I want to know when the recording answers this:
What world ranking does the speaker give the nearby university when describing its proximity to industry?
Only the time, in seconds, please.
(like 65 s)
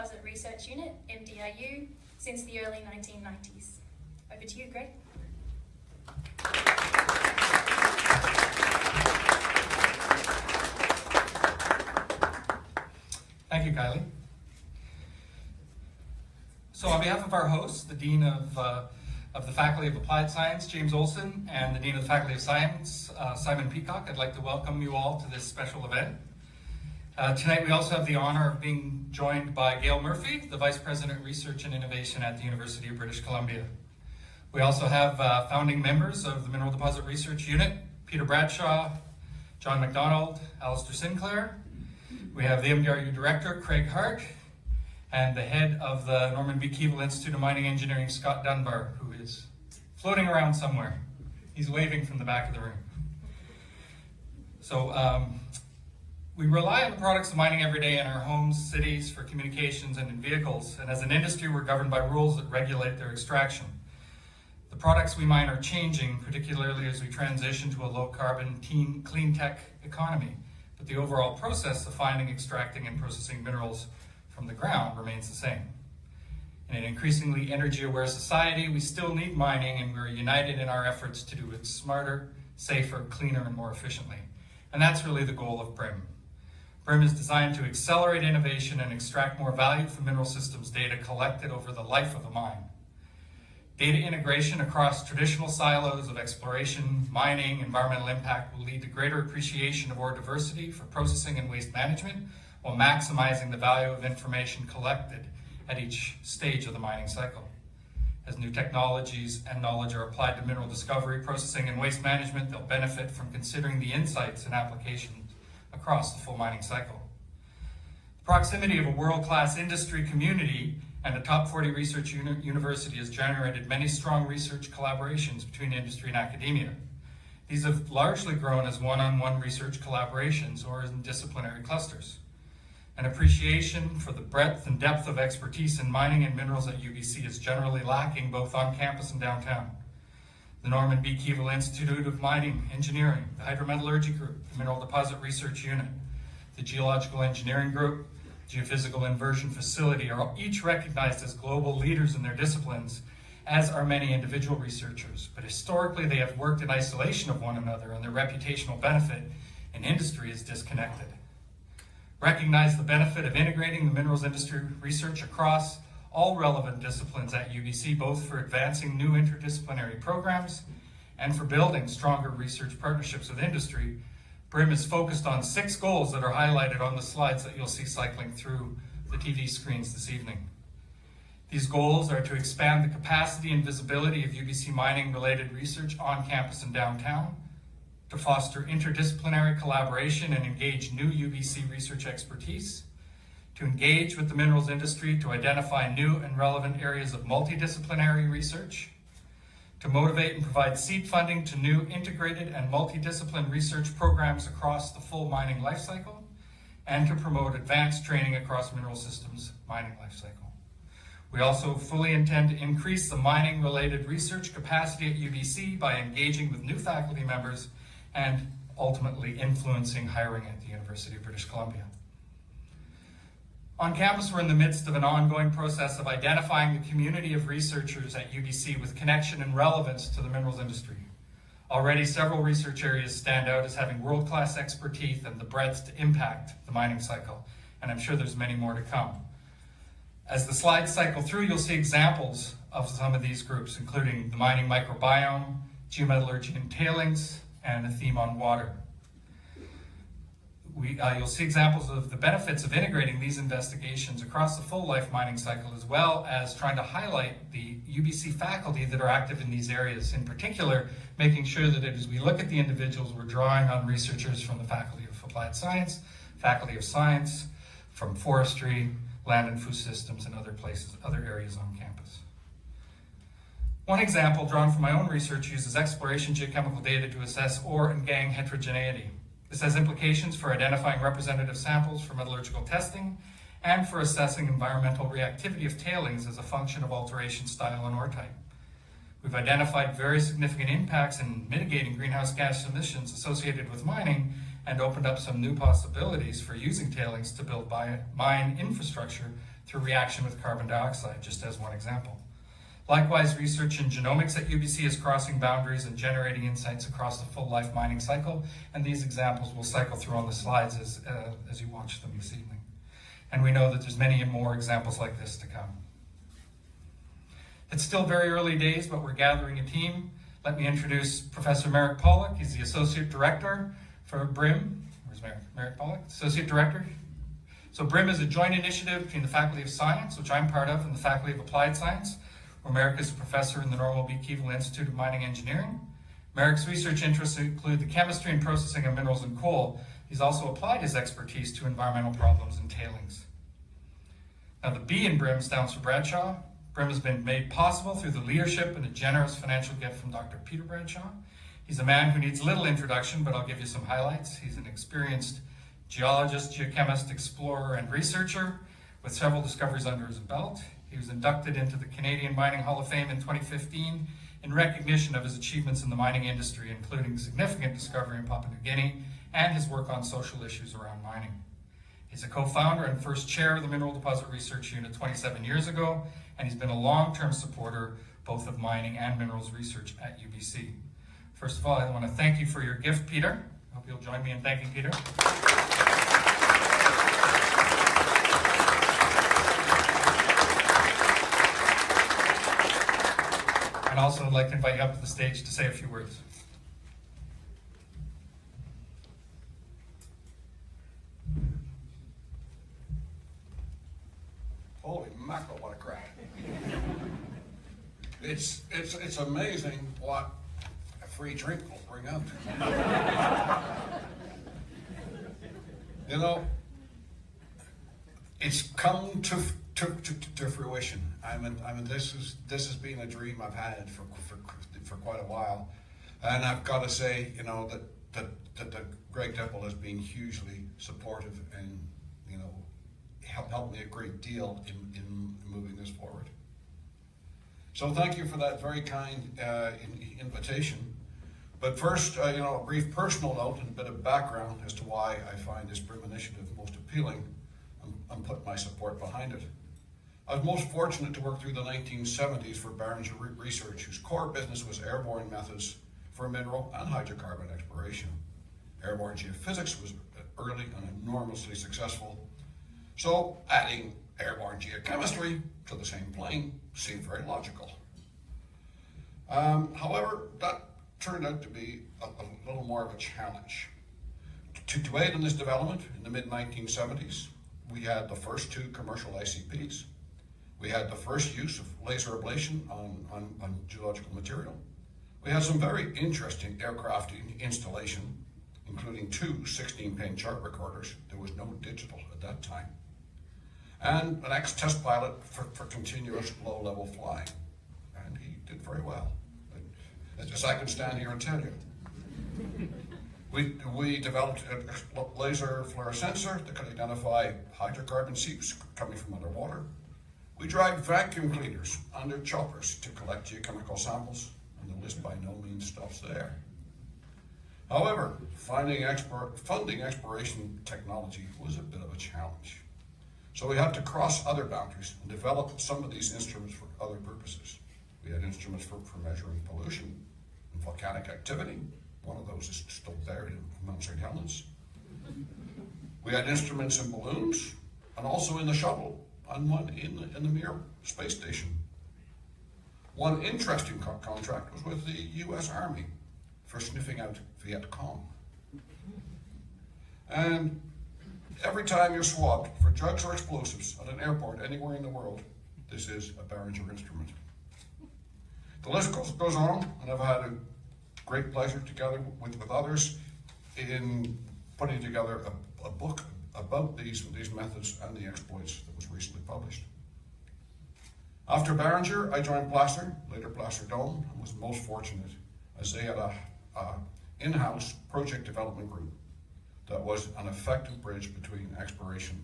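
121 s.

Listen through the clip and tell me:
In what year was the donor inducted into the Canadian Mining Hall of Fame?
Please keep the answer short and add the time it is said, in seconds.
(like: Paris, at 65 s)
2015, at 363 s.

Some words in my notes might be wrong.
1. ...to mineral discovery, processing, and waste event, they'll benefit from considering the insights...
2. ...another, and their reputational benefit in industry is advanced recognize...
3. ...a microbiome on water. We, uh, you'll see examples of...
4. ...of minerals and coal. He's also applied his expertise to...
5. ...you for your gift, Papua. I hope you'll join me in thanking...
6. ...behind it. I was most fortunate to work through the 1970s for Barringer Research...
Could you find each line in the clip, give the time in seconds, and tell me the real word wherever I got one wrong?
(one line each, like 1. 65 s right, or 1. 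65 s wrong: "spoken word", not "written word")
1. 110 s wrong: "management", not "event"
2. 157 s wrong: "disconnected", not "advanced"
3. 247 s wrong: "theme", not "microbiome"
4. 338 s right
5. 382 s wrong: "Peter", not "Papua"
6. 448 s right.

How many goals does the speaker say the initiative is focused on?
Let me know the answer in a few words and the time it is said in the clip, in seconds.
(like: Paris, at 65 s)
6, at 175 s.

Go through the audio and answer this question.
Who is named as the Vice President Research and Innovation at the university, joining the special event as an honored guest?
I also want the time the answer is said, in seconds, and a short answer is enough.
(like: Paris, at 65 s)
Gail Murphy, at 29 s.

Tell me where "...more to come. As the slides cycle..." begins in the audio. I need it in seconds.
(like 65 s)
238 s.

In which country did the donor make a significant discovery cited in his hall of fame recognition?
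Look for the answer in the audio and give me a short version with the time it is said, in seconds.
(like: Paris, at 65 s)
Papua New Guinea, at 368 s.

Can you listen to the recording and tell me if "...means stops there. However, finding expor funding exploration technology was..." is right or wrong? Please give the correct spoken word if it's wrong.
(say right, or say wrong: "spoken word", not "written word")
right.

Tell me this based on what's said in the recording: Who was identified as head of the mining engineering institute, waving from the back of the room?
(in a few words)
Scott Dunbar.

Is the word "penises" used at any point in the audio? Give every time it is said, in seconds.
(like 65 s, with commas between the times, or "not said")
not said.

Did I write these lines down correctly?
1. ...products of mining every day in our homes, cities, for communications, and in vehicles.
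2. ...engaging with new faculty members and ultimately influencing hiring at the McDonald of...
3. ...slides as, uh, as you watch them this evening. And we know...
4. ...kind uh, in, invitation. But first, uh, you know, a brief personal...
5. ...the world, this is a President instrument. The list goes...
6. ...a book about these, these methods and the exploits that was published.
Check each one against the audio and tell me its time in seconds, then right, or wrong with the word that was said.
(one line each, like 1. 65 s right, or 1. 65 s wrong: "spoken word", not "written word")
1. 56 s right
2. 215 s wrong: "University", not "McDonald"
3. 310 s right
4. 438 s right
5. 554 s wrong: "Barringer", not "President"
6. 565 s right.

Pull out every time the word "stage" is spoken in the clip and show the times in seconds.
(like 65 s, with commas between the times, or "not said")
106 s, 395 s.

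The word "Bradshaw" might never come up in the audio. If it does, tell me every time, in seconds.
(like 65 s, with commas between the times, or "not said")
38 s, 345 s, 350 s.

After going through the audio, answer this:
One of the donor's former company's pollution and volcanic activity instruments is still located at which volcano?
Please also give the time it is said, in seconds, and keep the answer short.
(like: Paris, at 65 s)
Mount St. Helens, at 533 s.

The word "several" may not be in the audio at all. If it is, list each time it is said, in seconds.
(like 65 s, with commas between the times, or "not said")
232 s, 359 s.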